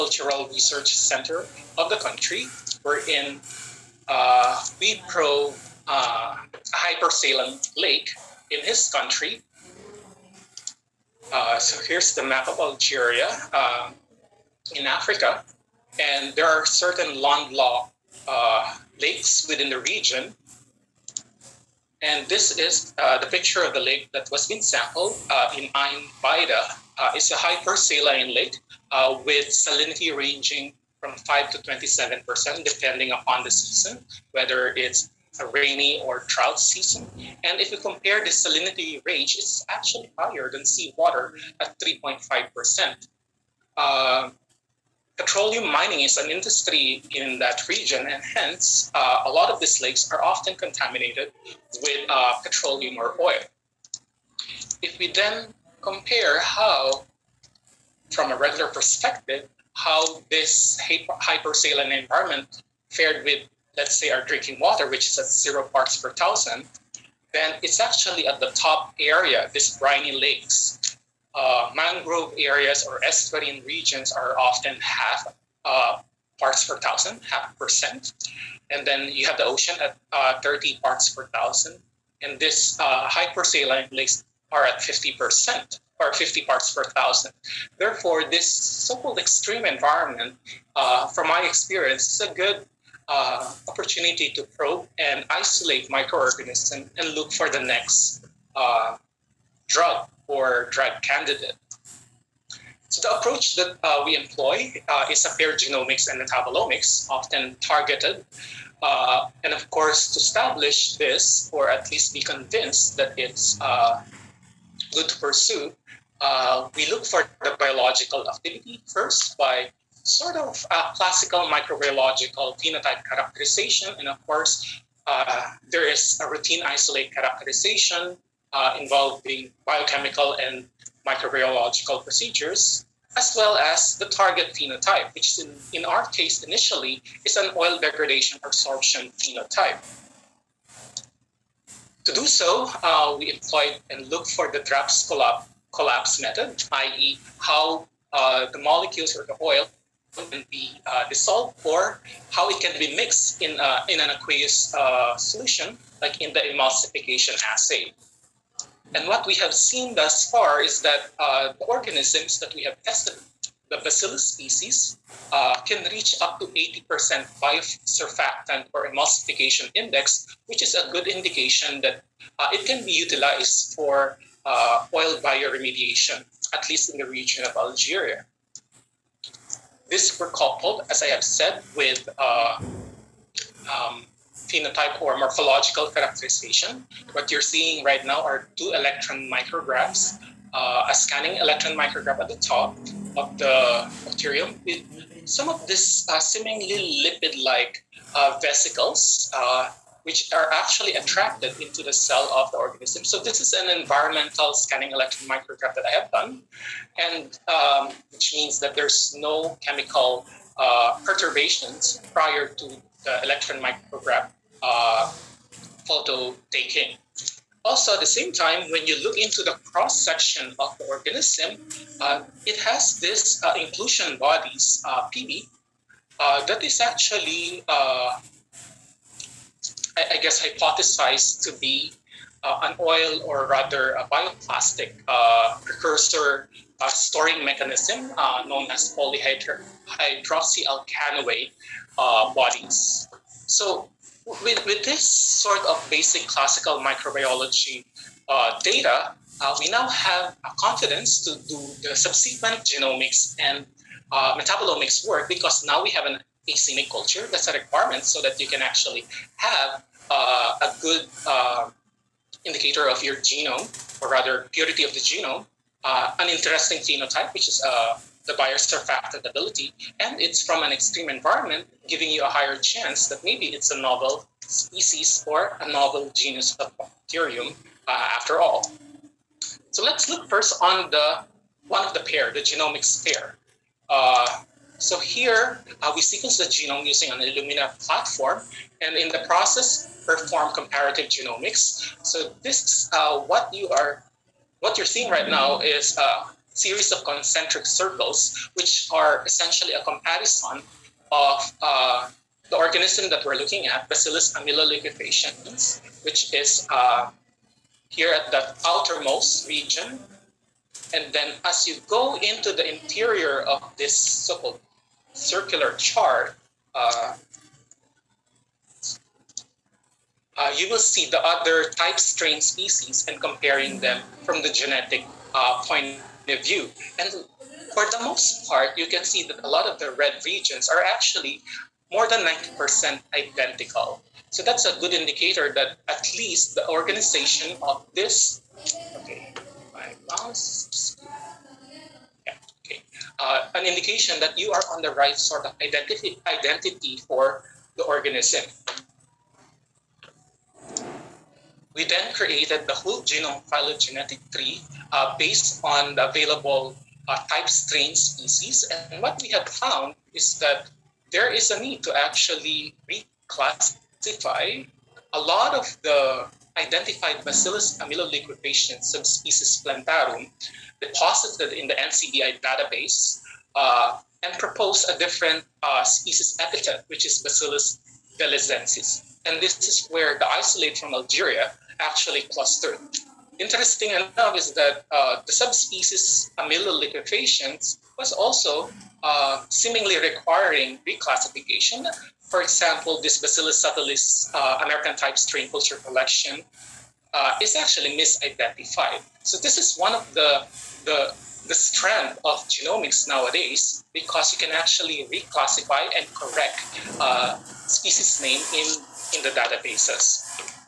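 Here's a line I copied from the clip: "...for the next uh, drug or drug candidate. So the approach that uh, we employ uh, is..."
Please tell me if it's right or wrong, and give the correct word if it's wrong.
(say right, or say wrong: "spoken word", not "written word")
right.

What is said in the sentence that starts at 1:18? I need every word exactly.
And then you have the ocean at uh, 30 parts per thousand.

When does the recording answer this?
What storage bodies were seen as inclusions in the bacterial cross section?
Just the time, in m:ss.
3:58.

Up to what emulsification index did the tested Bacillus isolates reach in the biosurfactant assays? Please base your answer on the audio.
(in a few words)
80%.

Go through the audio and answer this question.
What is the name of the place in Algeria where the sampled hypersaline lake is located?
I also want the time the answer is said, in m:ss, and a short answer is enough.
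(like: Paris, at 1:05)
Ain Baida, at 0:25.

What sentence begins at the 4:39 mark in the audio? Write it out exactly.
So let's look first on the one of the pair, the genomics pair.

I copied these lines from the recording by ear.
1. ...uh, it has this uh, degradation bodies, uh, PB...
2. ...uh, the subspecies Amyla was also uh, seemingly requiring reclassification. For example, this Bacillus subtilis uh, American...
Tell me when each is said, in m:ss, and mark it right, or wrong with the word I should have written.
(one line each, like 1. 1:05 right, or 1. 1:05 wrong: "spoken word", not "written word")
1. 3:42 wrong: "inclusion", not "degradation"
2. 6:24 right.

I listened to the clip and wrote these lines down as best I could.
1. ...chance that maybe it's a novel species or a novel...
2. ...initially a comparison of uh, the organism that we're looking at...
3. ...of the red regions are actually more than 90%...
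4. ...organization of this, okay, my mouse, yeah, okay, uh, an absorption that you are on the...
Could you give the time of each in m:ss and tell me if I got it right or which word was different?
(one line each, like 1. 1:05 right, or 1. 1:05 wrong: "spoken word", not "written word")
1. 4:32 right
2. 4:59 wrong: "essentially", not "initially"
3. 5:29 right
4. 5:36 wrong: "indication", not "absorption".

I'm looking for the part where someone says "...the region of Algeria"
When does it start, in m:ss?
2:56.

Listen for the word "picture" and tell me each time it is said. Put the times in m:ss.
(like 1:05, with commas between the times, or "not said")
0:23.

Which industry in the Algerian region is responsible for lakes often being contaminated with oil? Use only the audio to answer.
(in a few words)
Petroleum mining.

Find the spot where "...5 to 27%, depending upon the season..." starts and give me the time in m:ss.
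0:31.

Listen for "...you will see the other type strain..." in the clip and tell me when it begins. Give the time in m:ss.
5:20.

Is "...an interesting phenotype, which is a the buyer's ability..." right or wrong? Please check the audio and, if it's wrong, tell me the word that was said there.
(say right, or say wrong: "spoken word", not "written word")
right.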